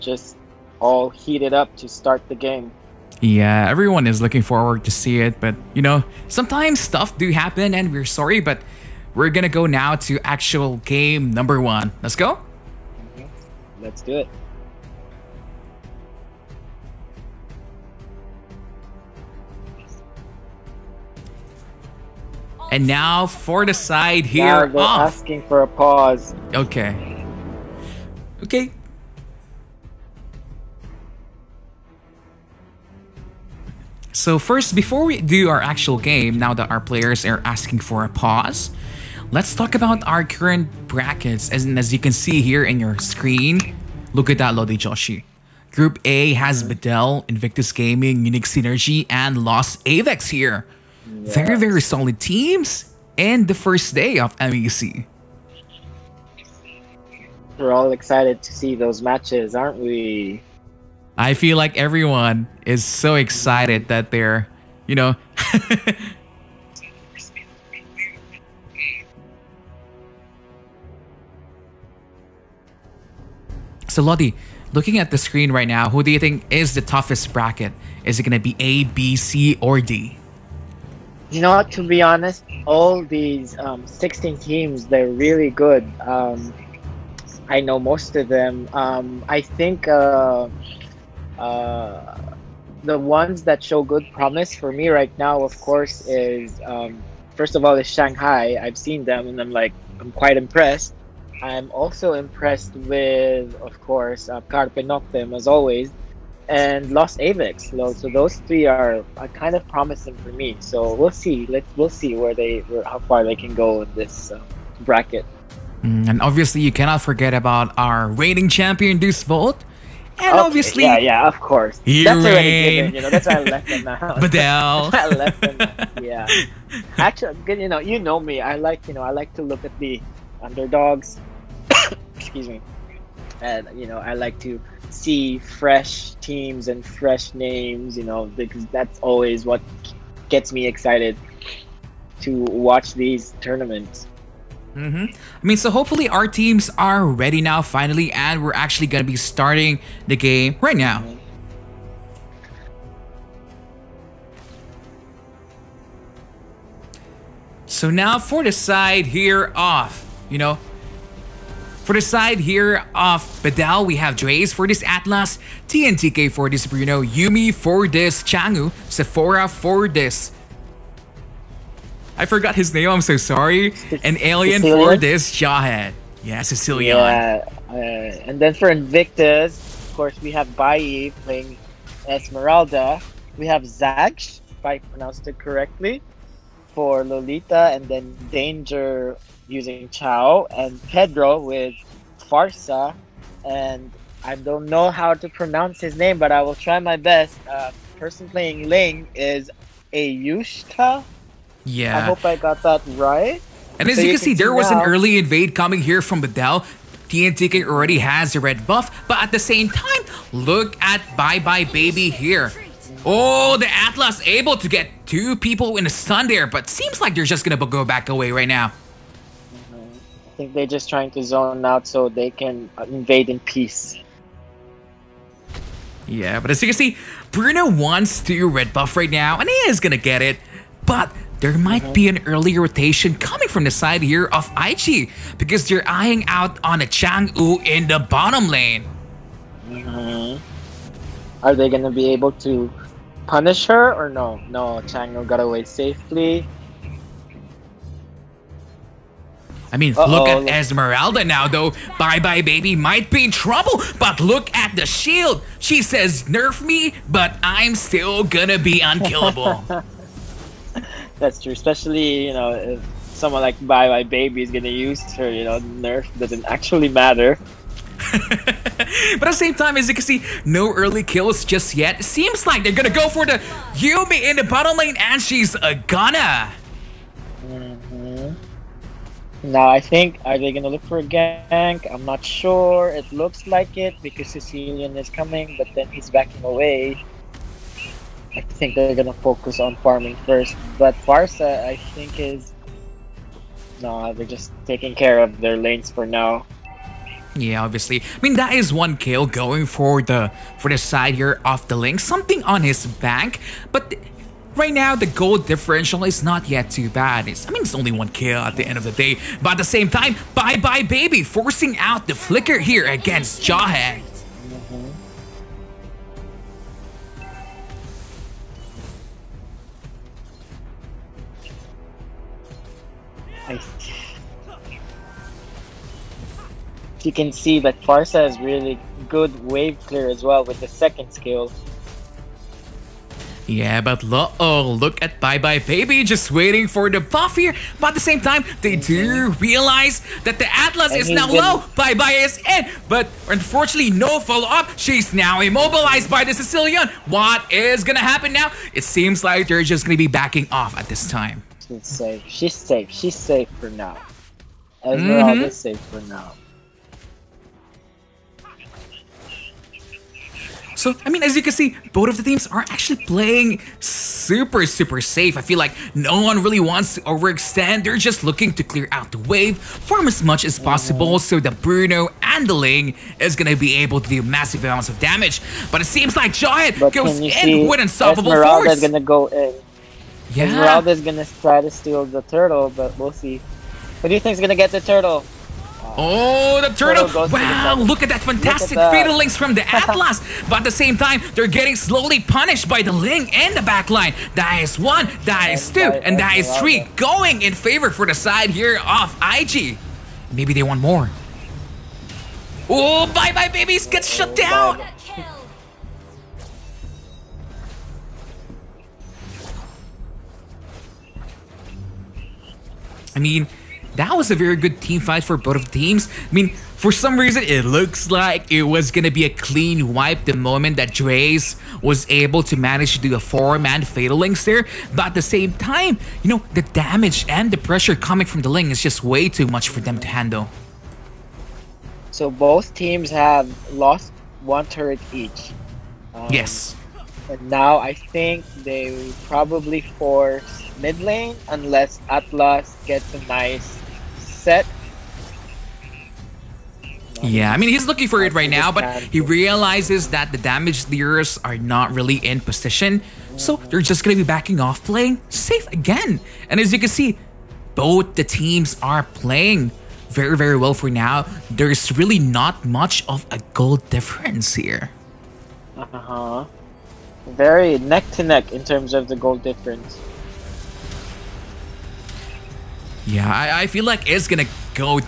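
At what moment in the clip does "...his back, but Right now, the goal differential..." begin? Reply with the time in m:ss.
5:02.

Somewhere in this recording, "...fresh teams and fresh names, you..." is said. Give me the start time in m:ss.
2:15.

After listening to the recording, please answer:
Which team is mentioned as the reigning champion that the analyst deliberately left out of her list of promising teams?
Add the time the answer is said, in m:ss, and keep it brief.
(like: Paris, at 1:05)
Deuce Volt, at 1:58.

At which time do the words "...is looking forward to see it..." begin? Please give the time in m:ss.
0:04.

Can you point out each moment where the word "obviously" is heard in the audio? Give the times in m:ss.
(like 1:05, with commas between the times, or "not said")
1:56, 2:00, 4:57.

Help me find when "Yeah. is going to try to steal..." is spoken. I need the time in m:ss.
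6:20.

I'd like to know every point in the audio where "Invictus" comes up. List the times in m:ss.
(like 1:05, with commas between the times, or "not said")
0:47, 2:58.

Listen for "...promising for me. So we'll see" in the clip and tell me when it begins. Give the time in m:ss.
1:49.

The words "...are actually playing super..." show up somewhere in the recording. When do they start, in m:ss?
6:02.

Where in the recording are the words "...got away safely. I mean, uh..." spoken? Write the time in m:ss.
4:05.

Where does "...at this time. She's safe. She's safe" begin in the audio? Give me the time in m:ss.
5:50.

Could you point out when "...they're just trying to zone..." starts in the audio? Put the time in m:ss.
3:40.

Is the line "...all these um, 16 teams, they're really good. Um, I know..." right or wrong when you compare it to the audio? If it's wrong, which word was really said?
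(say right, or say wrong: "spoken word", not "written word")
right.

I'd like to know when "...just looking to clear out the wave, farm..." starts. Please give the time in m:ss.
6:07.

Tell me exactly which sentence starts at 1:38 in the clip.
I've seen them, and I'm like, I'm quite impressed.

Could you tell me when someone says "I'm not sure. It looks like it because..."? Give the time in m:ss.
4:41.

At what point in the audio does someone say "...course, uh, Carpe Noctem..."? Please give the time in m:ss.
1:43.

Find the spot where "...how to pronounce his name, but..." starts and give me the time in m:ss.
3:14.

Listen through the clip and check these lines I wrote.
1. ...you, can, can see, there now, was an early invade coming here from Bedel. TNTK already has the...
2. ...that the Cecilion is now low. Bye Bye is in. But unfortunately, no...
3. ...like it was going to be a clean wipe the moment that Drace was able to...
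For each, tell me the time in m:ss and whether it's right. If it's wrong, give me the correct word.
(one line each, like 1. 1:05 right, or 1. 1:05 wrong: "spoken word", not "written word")
1. 3:24 right
2. 5:40 wrong: "Atlas", not "Cecilion"
3. 6:58 right.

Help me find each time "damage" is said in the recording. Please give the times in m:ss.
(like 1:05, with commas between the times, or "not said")
6:15, 7:06, 7:30.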